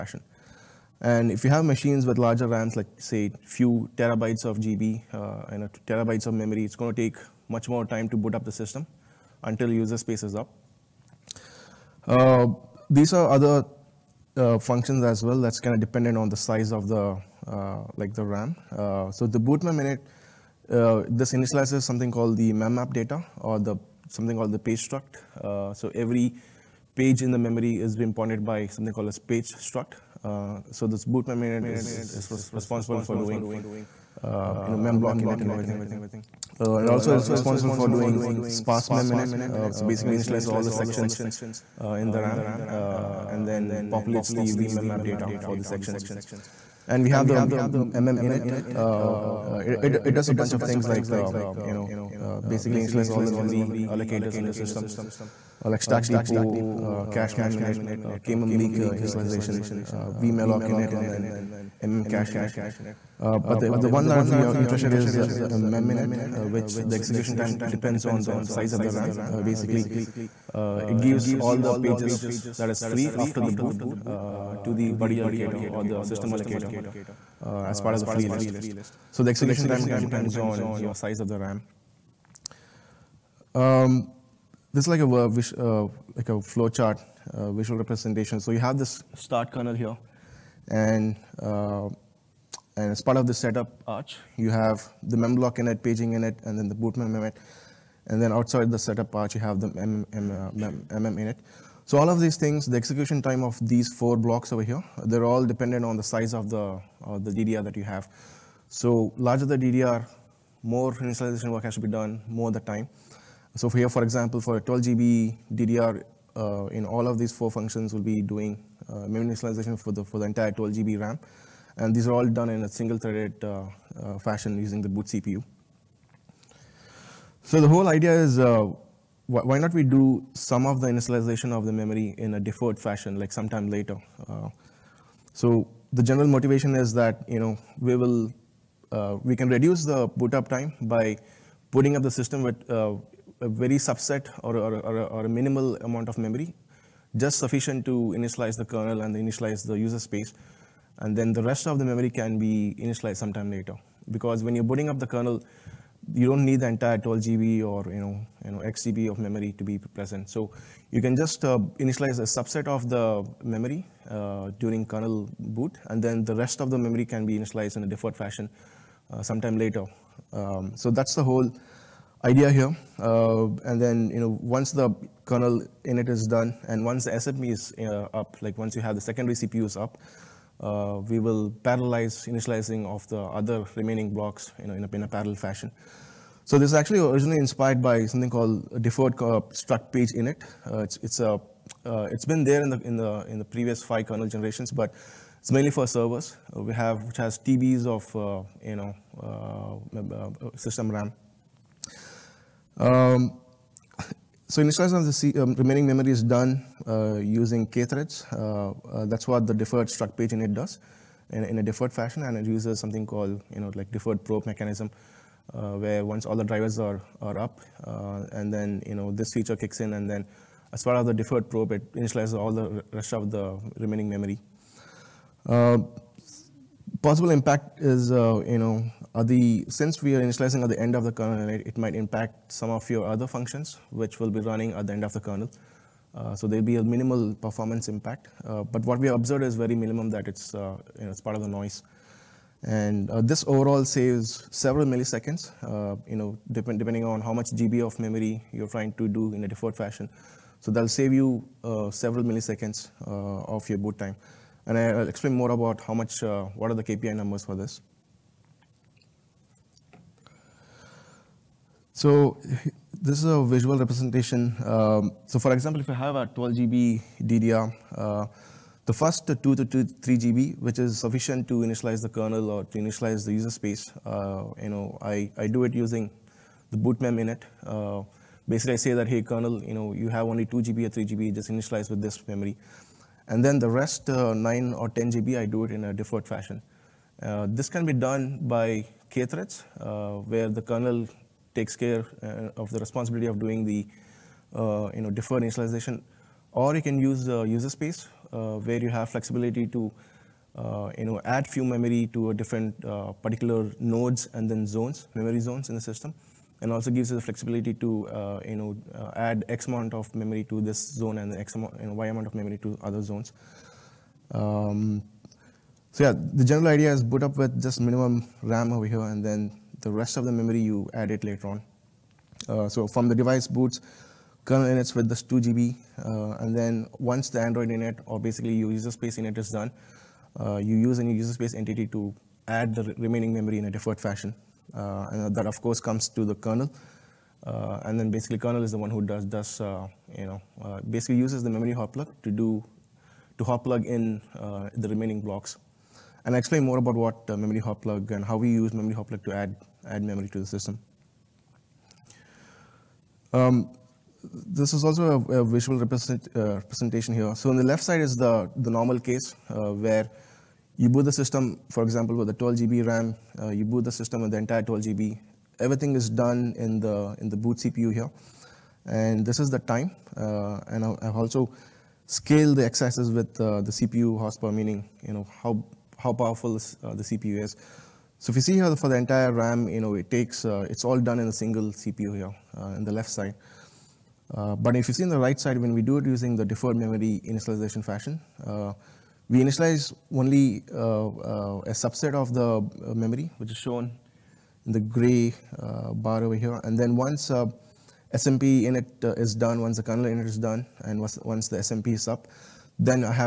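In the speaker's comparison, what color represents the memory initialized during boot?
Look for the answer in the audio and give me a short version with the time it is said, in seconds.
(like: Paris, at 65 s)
gray, at 394 s.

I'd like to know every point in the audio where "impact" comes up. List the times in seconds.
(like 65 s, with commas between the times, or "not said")
227 s, 231 s, 237 s.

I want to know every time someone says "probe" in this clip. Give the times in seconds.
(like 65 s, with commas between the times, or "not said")
214 s, 221 s.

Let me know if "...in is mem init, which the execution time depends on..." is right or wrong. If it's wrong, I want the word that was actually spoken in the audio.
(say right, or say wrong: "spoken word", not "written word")
right.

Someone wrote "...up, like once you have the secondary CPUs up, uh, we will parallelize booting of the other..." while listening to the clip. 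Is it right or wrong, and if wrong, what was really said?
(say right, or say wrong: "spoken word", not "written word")
wrong: "initializing", not "booting".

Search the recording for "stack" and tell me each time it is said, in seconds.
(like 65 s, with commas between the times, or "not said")
55 s.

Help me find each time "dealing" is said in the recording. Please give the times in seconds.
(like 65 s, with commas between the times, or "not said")
not said.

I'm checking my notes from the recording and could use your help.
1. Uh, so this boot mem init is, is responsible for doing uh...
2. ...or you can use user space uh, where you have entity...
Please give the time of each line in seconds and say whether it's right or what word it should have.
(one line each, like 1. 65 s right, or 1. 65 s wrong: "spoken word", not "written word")
1. 30 s right
2. 296 s wrong: "flexibility", not "entity".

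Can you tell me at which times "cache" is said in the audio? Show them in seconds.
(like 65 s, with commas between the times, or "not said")
57 s, 62 s.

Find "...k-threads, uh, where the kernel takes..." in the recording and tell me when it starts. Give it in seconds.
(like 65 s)
289 s.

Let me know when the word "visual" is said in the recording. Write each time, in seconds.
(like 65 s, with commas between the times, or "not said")
87 s, 263 s, 355 s.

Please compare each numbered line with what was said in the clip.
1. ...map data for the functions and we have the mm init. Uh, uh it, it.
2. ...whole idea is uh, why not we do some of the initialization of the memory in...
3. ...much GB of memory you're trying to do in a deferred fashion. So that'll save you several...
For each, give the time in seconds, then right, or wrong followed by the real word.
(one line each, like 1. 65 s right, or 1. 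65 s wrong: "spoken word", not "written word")
1. 44 s wrong: "sections", not "functions"
2. 127 s right
3. 247 s right.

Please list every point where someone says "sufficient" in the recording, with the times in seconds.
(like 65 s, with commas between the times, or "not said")
147 s, 270 s.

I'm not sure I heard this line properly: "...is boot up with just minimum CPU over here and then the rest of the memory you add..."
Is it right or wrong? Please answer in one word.
wrong.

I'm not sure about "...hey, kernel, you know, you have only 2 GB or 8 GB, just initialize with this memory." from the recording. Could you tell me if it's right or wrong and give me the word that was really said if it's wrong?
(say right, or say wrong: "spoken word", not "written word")
wrong: "3", not "8".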